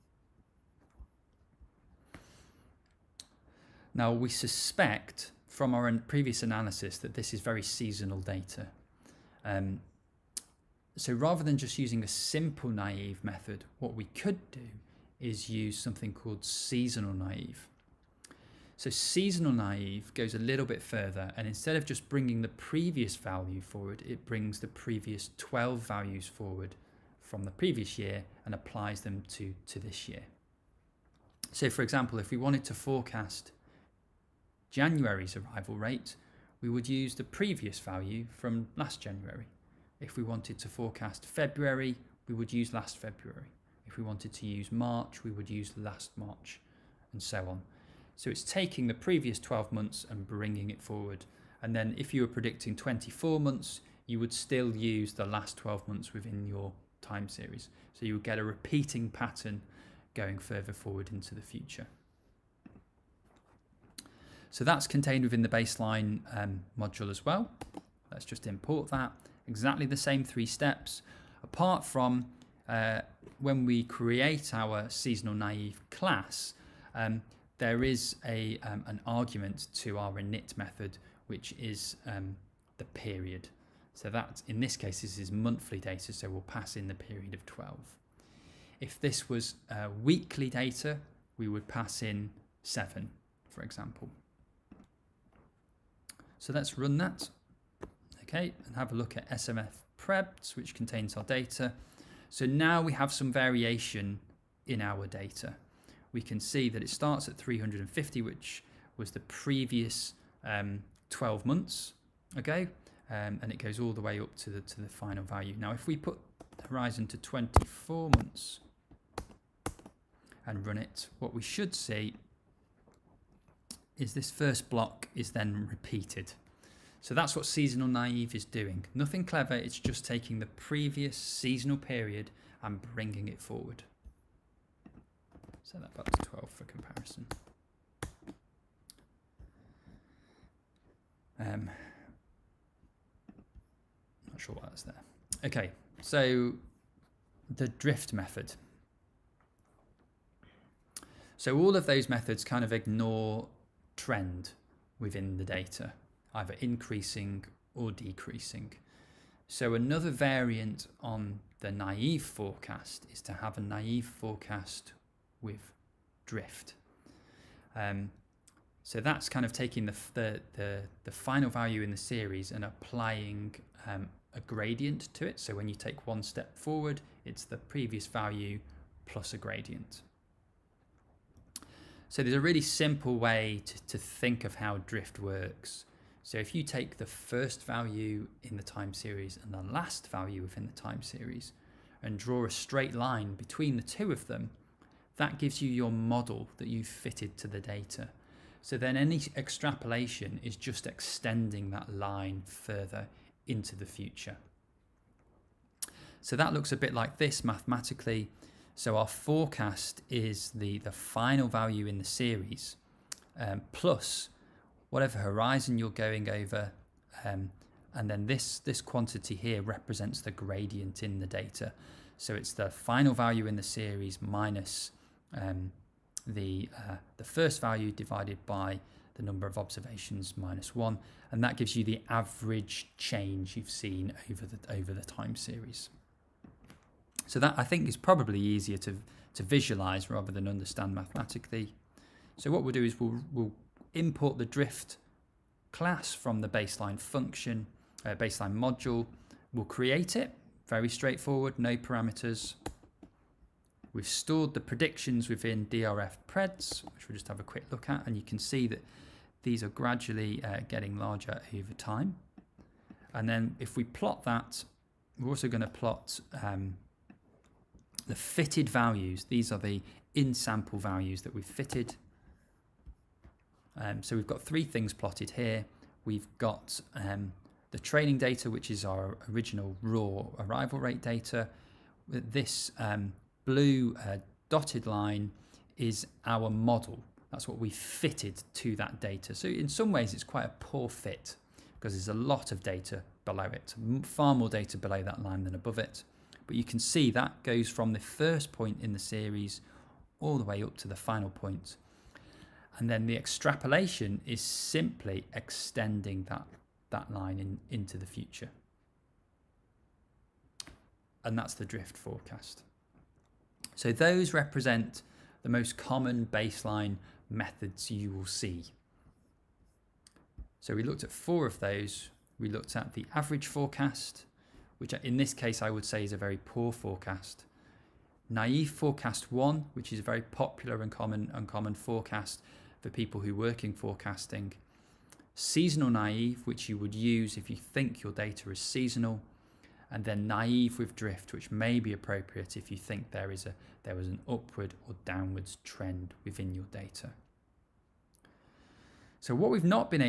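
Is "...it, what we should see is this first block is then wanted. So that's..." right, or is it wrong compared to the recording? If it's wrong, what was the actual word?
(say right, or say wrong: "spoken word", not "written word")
wrong: "repeated", not "wanted".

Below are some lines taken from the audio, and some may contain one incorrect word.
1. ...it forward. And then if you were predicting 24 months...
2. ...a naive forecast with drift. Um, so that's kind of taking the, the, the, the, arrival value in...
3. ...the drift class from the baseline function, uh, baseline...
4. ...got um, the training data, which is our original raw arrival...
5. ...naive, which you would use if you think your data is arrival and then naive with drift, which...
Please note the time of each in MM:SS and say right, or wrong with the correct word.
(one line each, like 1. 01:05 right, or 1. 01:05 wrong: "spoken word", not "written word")
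1. 00:50 right
2. 02:43 wrong: "final", not "arrival"
3. 04:04 right
4. 04:36 right
5. 05:35 wrong: "seasonal", not "arrival".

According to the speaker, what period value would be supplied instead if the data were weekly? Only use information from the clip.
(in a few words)
7.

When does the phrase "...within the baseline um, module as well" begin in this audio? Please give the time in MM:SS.
01:05.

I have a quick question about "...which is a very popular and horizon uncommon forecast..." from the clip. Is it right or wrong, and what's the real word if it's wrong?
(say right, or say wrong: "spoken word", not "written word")
wrong: "common", not "horizon".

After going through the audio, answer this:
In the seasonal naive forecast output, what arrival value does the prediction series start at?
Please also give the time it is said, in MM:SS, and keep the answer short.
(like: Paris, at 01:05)
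350, at 01:46.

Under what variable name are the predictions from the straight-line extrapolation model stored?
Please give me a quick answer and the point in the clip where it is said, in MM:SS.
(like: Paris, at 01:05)
DRF preds, at 04:15.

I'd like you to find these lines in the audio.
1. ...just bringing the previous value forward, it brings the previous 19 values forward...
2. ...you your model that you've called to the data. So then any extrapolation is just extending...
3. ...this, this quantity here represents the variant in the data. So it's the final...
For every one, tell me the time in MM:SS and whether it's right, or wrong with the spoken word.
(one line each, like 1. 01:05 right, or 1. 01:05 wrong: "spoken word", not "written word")
1. 00:21 wrong: "12", not "19"
2. 03:15 wrong: "fitted", not "called"
3. 03:38 wrong: "gradient", not "variant".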